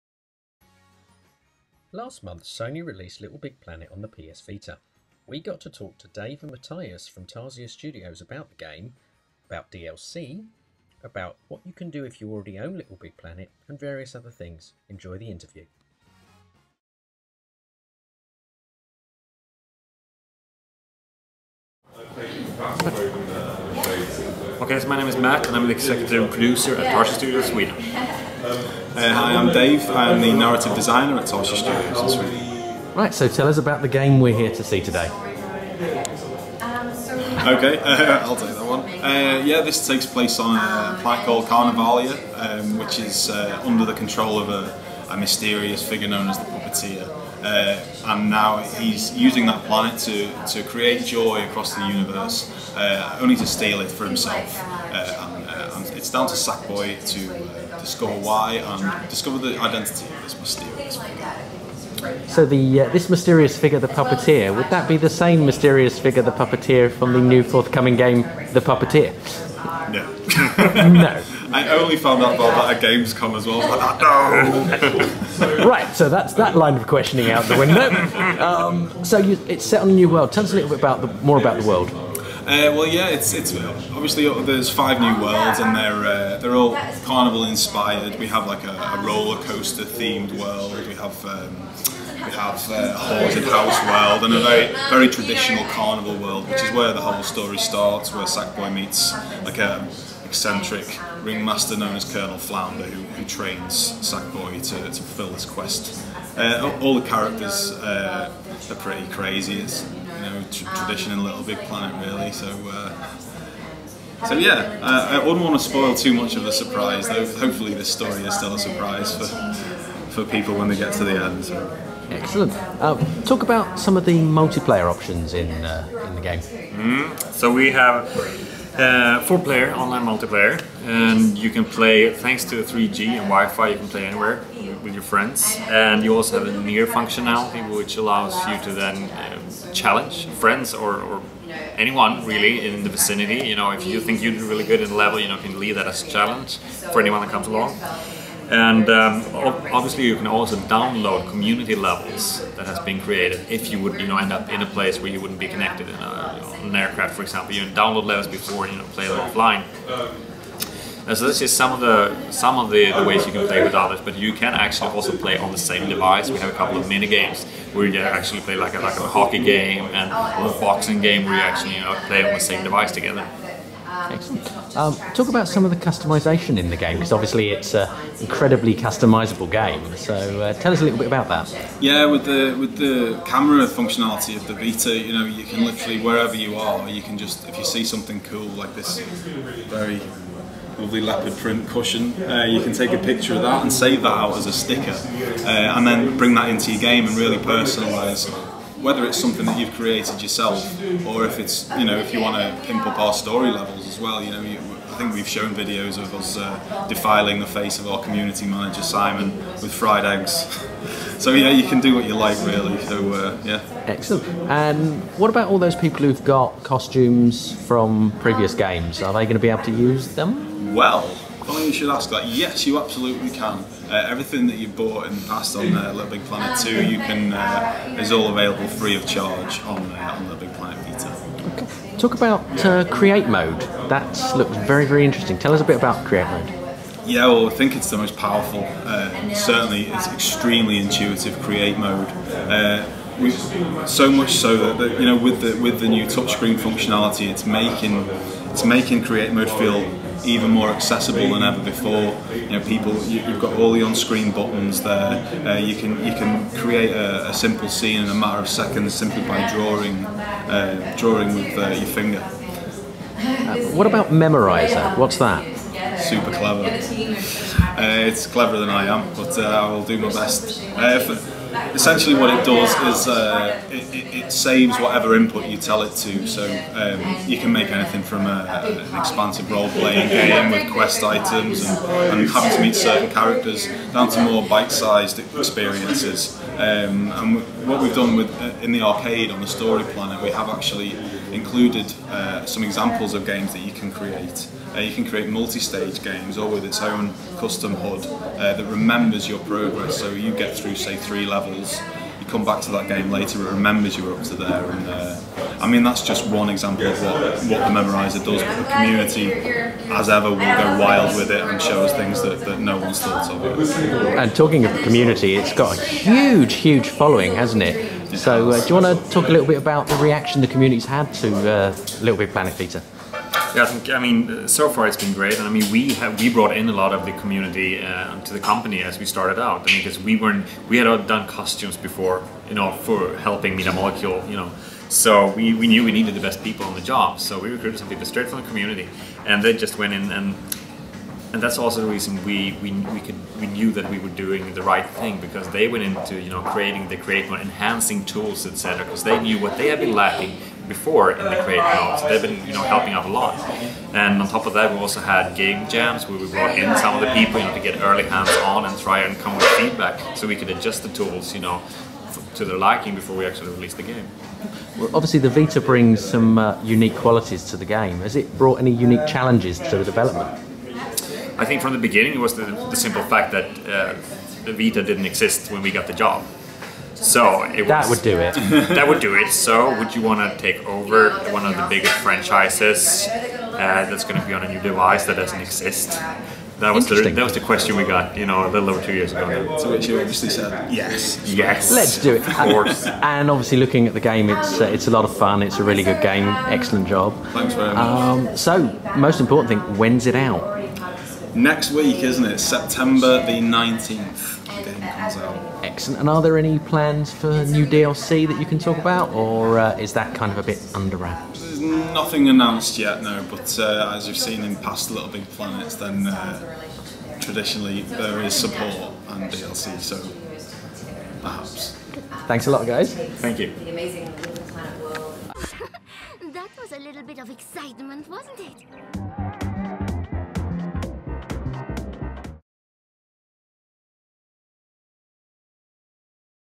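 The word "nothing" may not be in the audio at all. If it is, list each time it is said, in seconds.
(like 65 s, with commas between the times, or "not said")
411 s.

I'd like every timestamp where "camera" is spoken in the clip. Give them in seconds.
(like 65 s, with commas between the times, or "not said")
183 s.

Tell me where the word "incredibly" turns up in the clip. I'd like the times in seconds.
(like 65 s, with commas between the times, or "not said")
178 s.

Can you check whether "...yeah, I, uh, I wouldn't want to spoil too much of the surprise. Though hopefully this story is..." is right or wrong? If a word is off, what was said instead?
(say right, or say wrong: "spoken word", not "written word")
right.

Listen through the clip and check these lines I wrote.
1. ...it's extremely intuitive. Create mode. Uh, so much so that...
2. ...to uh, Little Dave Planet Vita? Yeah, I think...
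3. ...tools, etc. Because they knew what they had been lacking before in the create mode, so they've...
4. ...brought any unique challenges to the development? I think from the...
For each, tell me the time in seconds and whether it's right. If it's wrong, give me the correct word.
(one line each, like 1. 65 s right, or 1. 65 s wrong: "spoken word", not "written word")
1. 239 s right
2. 321 s wrong: "Big", not "Dave"
3. 348 s right
4. 368 s right.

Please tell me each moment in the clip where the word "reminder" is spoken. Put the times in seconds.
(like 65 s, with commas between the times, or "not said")
not said.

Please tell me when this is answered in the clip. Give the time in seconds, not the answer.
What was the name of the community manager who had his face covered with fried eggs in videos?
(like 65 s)
208 s.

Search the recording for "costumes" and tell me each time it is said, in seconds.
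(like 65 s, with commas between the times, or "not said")
216 s, 331 s.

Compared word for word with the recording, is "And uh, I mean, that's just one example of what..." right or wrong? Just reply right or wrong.
right.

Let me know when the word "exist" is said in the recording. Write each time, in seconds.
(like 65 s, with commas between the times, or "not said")
375 s, 385 s.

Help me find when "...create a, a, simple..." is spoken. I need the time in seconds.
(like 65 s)
256 s.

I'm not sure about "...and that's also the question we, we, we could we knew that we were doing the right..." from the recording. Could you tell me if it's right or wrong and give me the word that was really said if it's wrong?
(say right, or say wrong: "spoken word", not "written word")
wrong: "reason", not "question".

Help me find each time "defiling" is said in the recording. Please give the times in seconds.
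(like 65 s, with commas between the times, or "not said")
206 s.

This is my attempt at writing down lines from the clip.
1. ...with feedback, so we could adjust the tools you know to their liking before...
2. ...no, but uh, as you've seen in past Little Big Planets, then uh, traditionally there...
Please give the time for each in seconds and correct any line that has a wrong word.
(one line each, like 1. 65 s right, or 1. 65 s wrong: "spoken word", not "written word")
1. 359 s right
2. 413 s right.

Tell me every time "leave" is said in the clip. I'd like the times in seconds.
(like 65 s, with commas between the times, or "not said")
145 s.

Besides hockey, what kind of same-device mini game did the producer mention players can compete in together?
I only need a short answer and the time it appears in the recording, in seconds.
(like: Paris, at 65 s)
boxing, at 170 s.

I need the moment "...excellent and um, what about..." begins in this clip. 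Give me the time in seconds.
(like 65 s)
213 s.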